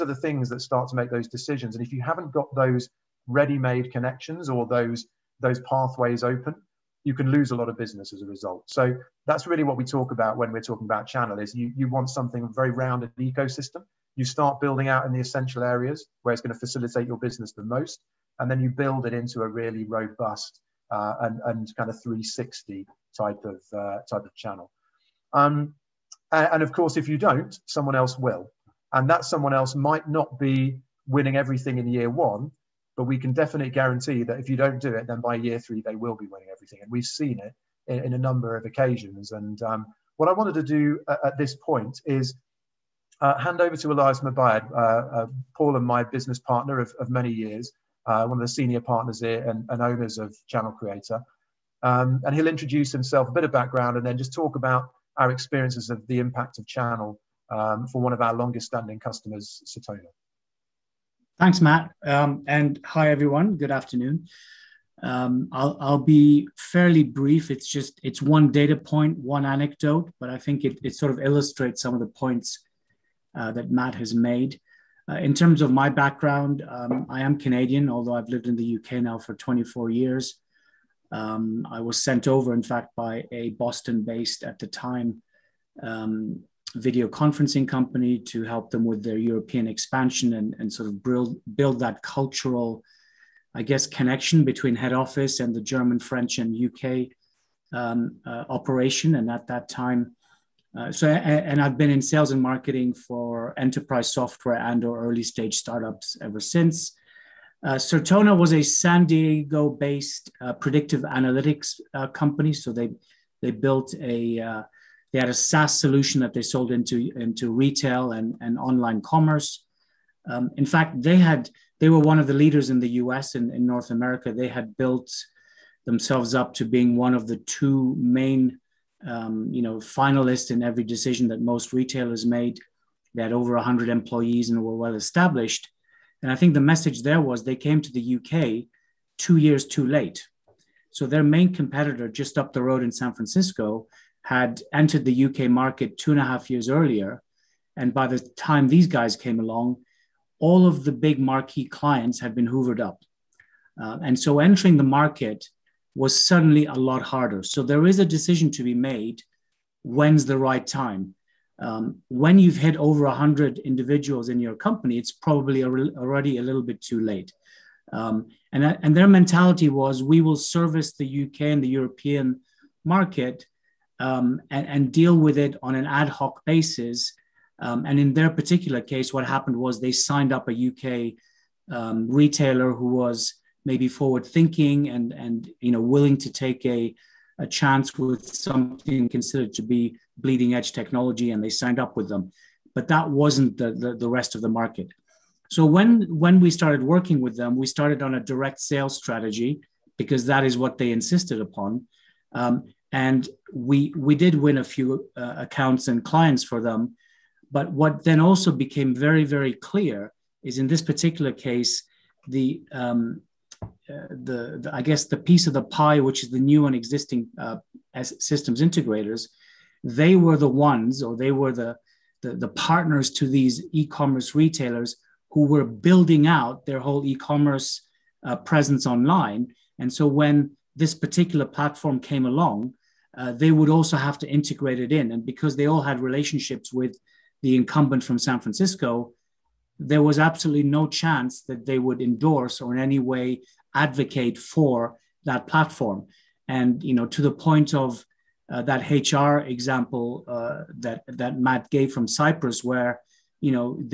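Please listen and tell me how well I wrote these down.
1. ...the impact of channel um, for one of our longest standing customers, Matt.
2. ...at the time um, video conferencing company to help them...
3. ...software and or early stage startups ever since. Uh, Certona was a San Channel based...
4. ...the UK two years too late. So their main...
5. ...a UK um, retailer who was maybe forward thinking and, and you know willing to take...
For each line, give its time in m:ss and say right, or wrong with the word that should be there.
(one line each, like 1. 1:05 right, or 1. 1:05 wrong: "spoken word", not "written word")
1. 0:56 wrong: "Certona", not "Matt"
2. 1:24 right
3. 1:44 wrong: "Diego", not "Channel"
4. 2:17 right
5. 3:00 right.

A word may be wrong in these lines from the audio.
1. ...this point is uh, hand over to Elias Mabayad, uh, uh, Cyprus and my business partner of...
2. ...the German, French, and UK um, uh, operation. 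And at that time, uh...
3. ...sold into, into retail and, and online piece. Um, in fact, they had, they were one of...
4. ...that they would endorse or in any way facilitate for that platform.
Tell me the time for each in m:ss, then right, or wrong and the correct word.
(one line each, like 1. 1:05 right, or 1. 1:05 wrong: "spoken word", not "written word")
1. 0:41 wrong: "Paul", not "Cyprus"
2. 1:35 right
3. 1:56 wrong: "commerce", not "piece"
4. 4:01 wrong: "advocate", not "facilitate".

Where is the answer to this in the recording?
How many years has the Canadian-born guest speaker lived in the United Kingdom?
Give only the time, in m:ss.
1:19.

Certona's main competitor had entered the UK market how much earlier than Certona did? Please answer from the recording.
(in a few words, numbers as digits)
2 and a half years.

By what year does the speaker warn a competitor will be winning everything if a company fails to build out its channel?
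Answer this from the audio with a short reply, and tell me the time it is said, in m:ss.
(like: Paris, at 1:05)
Year 3, at 0:35.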